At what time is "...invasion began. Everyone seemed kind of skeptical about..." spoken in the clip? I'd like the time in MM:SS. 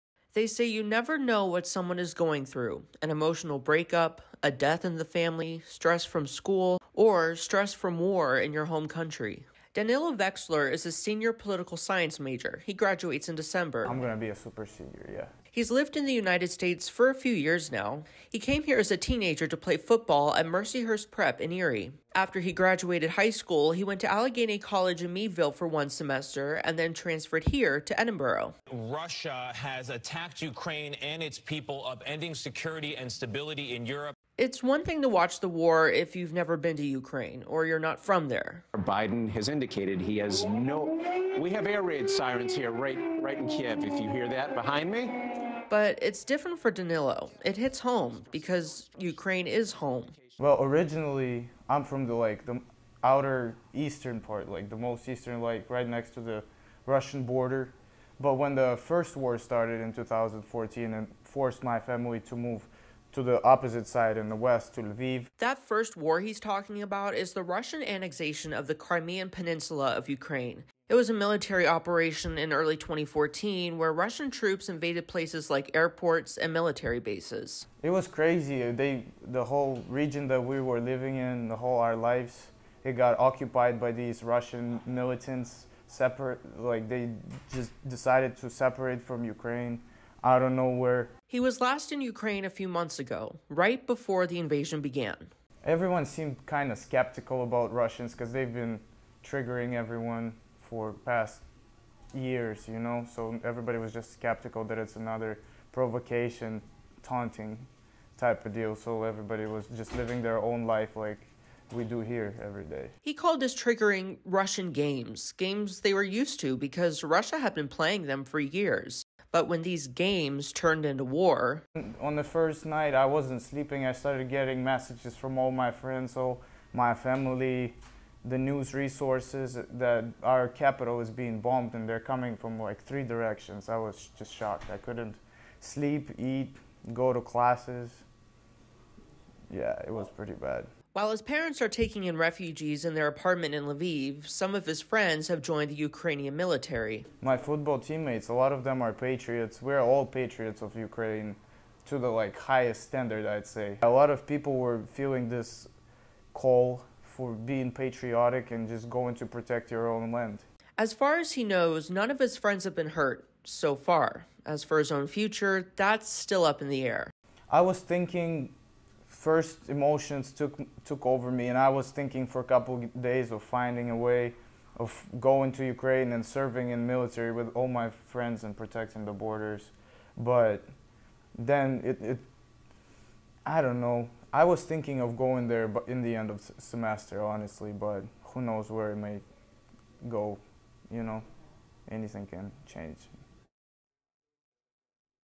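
01:34.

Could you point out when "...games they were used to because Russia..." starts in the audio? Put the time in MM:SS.
01:55.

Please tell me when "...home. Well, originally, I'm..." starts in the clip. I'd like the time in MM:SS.
00:49.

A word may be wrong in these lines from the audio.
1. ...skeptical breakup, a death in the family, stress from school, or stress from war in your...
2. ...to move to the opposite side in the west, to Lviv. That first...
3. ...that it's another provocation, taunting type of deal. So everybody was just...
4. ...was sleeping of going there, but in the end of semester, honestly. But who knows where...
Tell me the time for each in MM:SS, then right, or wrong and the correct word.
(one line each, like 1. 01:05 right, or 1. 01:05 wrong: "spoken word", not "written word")
1. 00:03 wrong: "emotional", not "skeptical"
2. 01:02 right
3. 01:44 right
4. 03:04 wrong: "thinking", not "sleeping".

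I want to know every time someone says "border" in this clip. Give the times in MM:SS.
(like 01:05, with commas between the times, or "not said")
00:57, 02:59.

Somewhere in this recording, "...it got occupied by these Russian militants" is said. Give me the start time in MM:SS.
01:22.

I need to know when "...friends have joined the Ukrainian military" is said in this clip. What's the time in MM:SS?
02:24.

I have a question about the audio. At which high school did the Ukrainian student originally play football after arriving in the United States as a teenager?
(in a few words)
Mercyhurst Prep.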